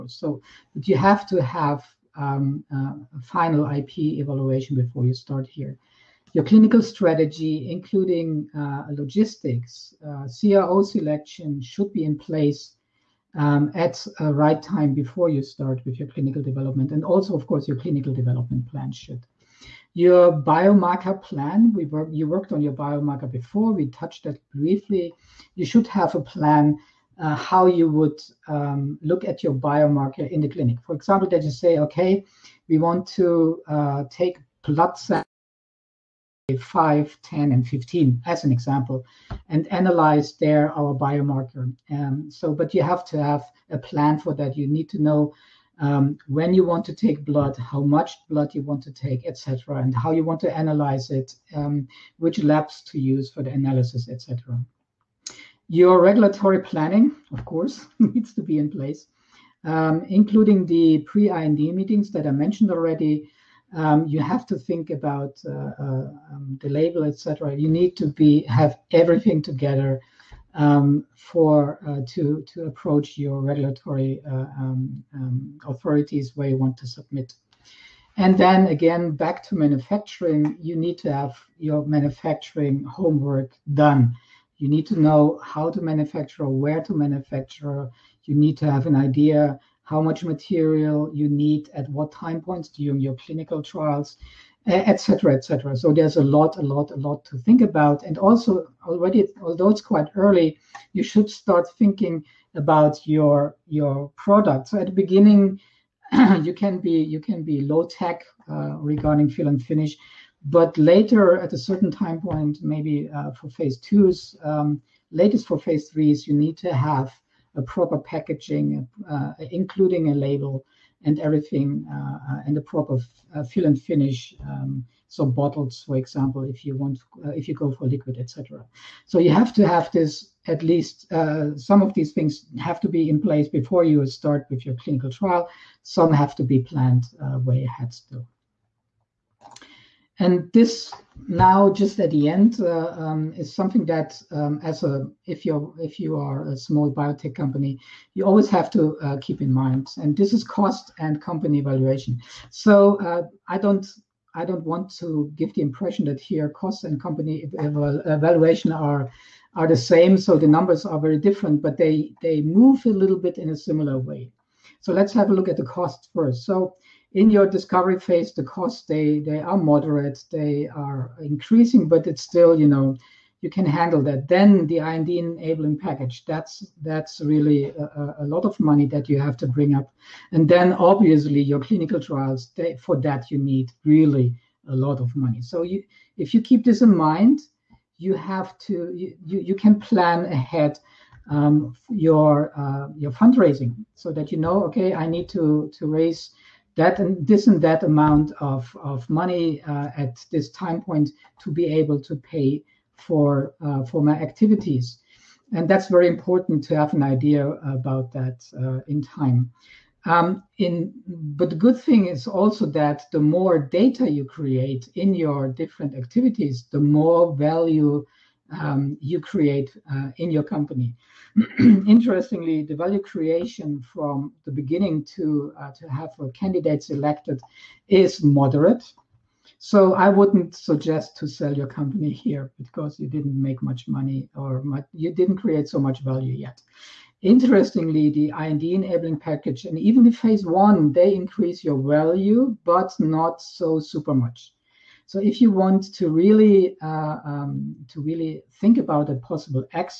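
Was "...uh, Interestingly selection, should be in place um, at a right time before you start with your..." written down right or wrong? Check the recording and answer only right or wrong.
wrong.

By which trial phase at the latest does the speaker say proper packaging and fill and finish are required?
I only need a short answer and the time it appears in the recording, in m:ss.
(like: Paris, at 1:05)
phase threes, at 1:55.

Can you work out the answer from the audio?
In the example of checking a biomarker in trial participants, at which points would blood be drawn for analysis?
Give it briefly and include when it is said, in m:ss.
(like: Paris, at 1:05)
5, 10, and 15, at 0:36.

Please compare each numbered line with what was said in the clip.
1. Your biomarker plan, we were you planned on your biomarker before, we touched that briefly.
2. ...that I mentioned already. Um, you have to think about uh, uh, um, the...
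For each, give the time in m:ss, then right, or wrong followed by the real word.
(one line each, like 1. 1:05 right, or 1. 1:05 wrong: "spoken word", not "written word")
1. 0:19 wrong: "worked", not "planned"
2. 1:02 right.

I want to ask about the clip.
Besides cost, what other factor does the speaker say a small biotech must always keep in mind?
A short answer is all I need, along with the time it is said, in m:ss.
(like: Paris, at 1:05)
company valuation, at 2:31.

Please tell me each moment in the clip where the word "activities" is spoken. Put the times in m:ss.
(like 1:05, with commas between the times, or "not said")
3:24, 3:35.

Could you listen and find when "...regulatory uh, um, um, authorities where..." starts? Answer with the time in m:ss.
1:13.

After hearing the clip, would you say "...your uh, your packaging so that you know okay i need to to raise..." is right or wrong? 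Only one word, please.
wrong.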